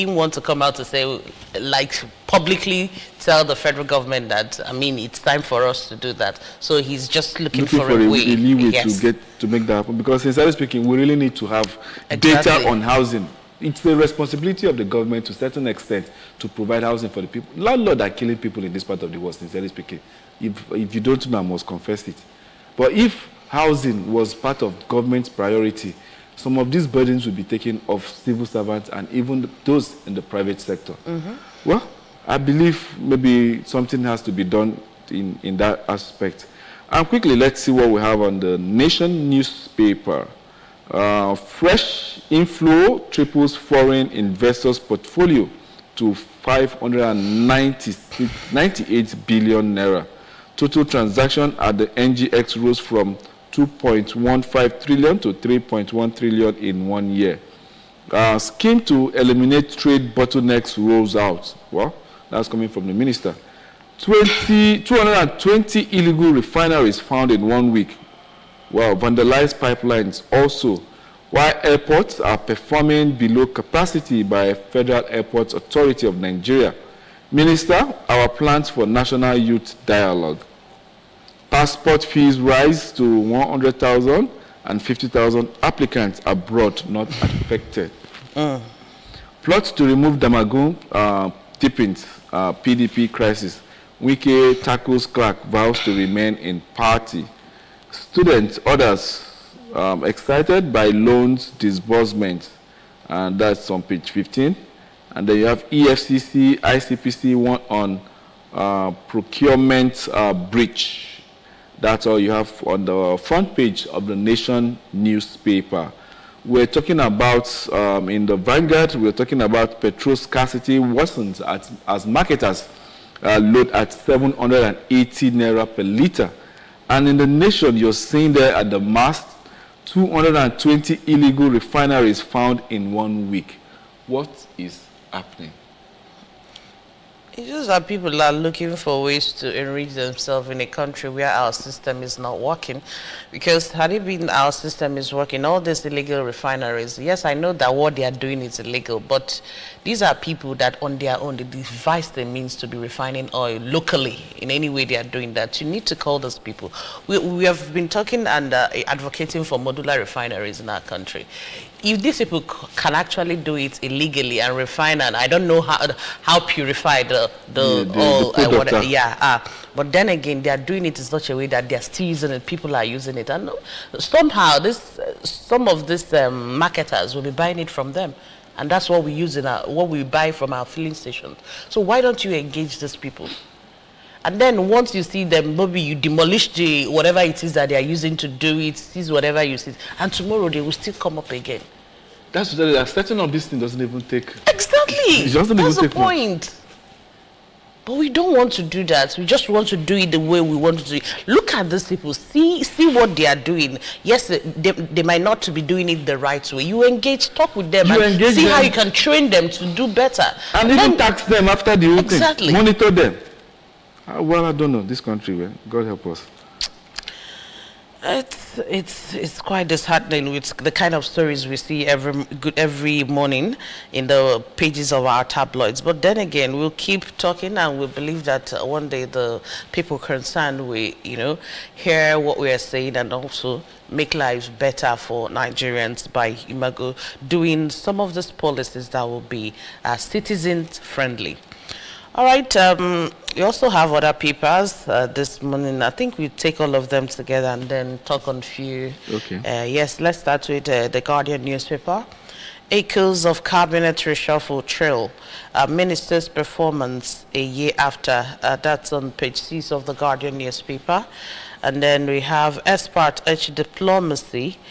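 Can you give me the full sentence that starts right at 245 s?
I think we take all of them together and then talk on few.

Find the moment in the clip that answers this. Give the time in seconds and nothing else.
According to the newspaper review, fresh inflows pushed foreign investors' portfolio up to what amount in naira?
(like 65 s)
46 s.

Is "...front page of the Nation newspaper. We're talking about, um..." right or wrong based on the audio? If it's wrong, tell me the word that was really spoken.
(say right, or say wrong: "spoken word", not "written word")
right.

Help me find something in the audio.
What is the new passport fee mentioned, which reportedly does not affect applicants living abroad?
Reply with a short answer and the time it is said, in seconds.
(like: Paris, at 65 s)
100,000, at 83 s.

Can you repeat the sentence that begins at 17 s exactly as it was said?
Landlords are killing people in this part of the world, sincerely speaking.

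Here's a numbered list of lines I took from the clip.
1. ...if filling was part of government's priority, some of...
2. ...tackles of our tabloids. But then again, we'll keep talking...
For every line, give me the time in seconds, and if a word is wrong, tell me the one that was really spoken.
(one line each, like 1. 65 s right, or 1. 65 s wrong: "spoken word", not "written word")
1. 22 s wrong: "housing", not "filling"
2. 224 s wrong: "pages", not "tackles".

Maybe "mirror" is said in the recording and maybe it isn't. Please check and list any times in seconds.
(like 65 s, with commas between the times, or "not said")
not said.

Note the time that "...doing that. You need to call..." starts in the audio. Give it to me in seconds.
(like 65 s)
155 s.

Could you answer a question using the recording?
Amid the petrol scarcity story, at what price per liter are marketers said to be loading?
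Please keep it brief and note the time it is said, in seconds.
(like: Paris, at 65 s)
780 naira, at 123 s.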